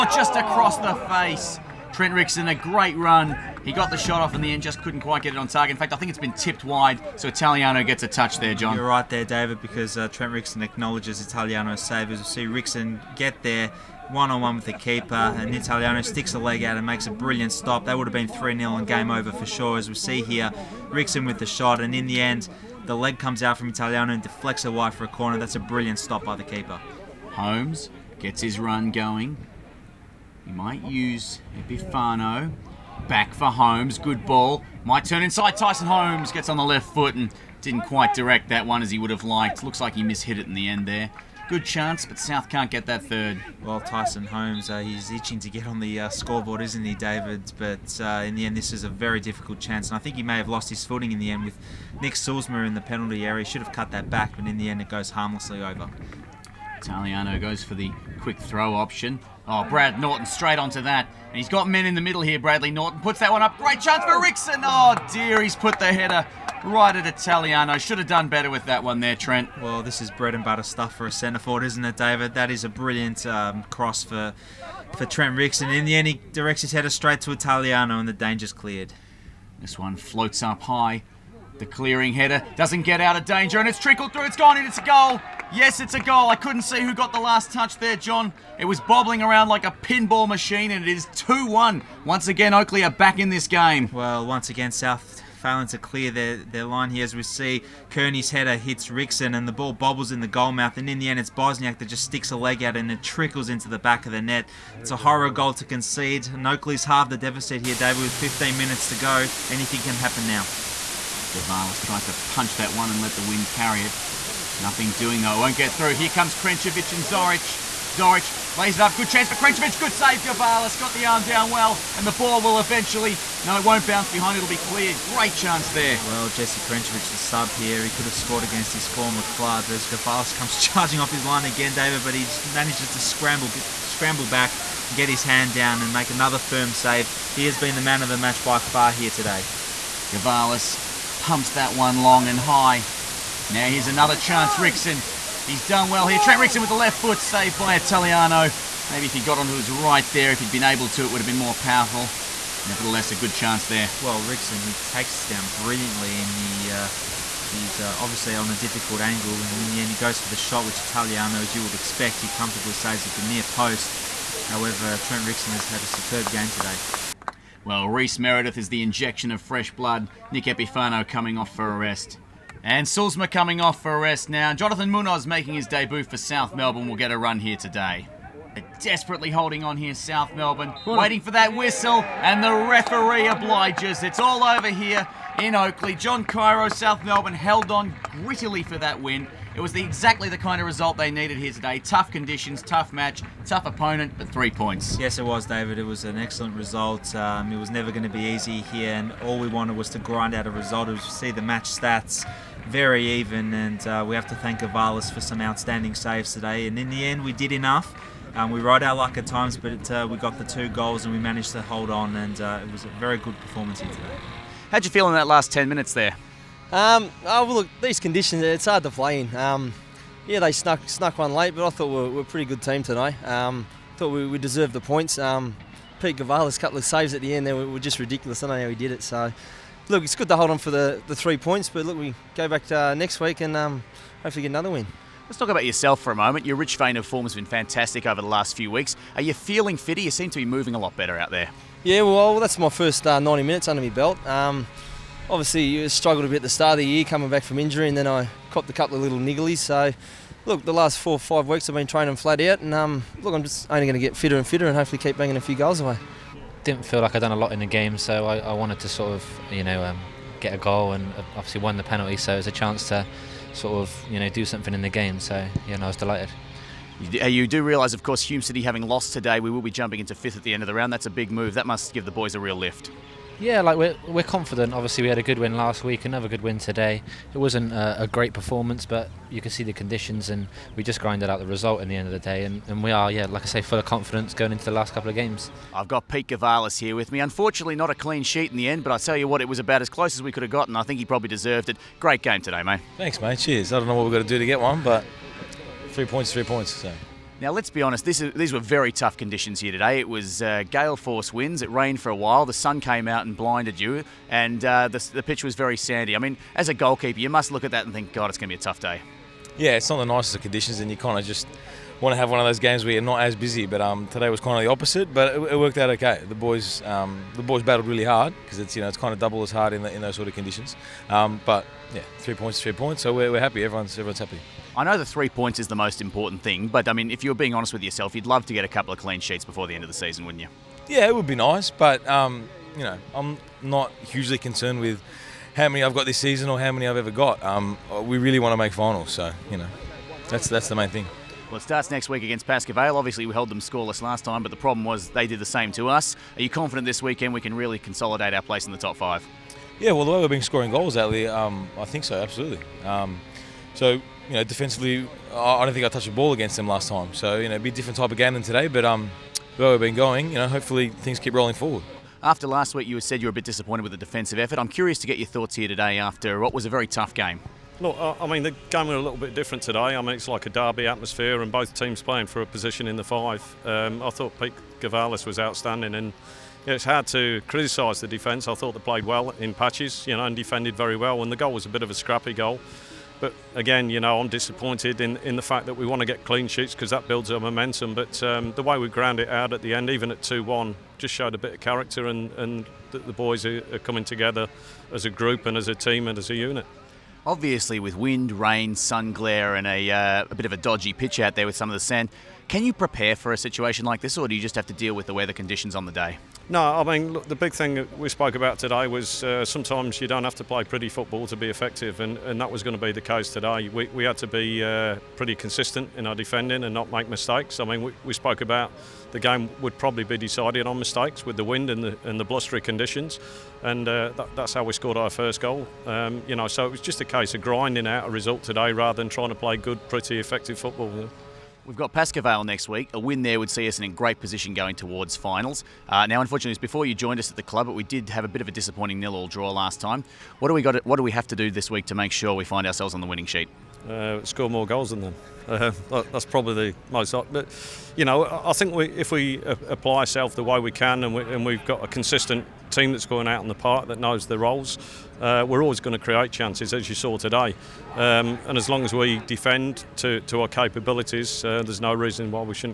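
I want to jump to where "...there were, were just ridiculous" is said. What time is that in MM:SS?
03:47.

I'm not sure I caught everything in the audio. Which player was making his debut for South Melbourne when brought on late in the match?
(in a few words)
Jonathan Munoz.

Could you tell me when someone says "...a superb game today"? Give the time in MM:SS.
02:45.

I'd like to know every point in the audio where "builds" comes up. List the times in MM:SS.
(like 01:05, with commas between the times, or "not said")
06:27.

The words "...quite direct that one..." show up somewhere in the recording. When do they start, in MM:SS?
00:37.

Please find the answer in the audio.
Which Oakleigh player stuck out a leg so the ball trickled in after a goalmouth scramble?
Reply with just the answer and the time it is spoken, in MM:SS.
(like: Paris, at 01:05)
Bosniak, at 01:41.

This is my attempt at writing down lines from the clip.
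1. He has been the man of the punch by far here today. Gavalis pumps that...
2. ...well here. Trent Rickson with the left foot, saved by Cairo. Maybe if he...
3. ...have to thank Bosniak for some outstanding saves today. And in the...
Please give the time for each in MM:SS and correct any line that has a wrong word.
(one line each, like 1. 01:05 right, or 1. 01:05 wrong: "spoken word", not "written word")
1. 02:17 wrong: "match", not "punch"
2. 02:25 wrong: "Italiano", not "Cairo"
3. 03:24 wrong: "Avalis", not "Bosniak".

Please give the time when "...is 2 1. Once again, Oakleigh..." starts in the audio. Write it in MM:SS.
01:30.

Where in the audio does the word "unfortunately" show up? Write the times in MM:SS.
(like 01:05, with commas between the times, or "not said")
04:47, 07:16.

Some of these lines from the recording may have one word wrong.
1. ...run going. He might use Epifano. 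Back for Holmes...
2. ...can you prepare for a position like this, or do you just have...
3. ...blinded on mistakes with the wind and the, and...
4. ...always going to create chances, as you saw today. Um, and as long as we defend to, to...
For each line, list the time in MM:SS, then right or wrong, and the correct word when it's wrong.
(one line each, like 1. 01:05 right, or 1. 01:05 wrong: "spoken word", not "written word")
1. 00:28 right
2. 06:42 wrong: "situation", not "position"
3. 07:00 wrong: "decided", not "blinded"
4. 07:35 right.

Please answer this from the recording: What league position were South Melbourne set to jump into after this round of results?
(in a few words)
fifth.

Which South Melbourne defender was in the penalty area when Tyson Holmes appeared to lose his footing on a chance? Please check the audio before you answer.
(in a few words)
Nick Sulzma.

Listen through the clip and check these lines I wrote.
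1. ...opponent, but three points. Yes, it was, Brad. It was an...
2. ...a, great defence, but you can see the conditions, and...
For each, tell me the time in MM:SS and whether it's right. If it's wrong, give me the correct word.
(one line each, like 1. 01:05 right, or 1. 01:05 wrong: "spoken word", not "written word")
1. 03:13 wrong: "David", not "Brad"
2. 04:38 wrong: "performance", not "defence".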